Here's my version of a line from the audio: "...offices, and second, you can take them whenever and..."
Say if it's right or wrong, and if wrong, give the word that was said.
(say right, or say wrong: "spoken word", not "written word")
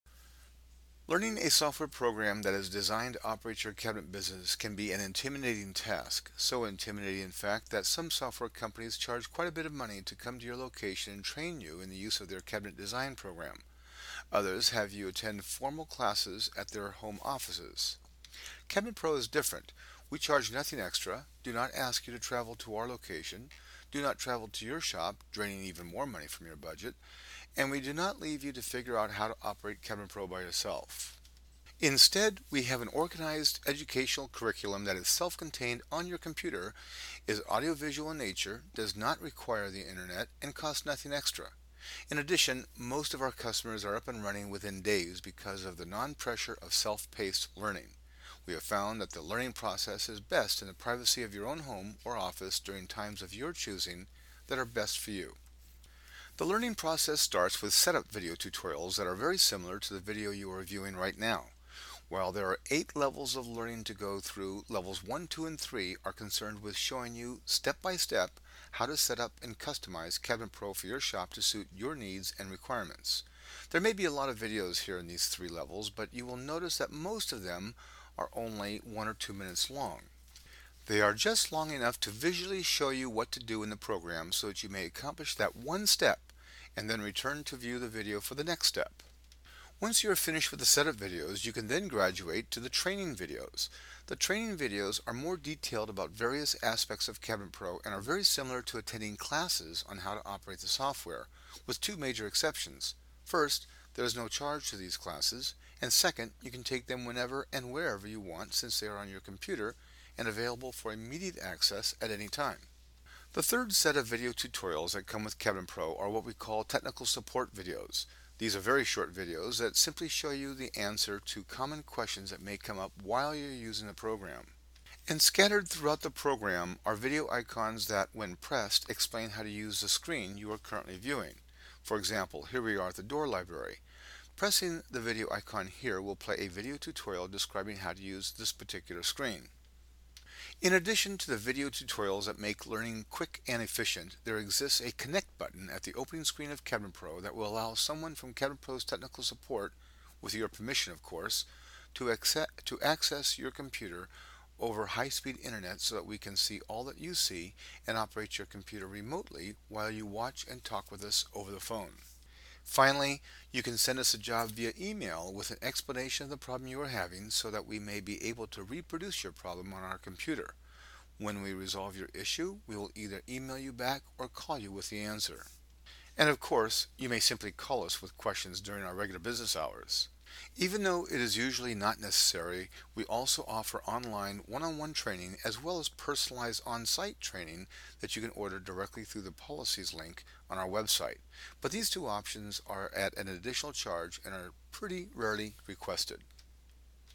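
wrong: "classes", not "offices".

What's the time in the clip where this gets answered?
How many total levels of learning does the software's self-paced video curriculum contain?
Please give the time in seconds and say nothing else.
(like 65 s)
62 s.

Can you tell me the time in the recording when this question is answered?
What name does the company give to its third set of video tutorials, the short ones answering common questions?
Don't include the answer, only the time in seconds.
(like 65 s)
116 s.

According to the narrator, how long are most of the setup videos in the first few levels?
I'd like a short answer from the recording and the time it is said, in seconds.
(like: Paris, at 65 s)
1 or 2 minutes, at 78 s.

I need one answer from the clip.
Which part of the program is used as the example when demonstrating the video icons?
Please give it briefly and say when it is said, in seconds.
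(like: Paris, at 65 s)
door library, at 133 s.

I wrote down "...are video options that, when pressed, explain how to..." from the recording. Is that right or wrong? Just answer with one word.
wrong.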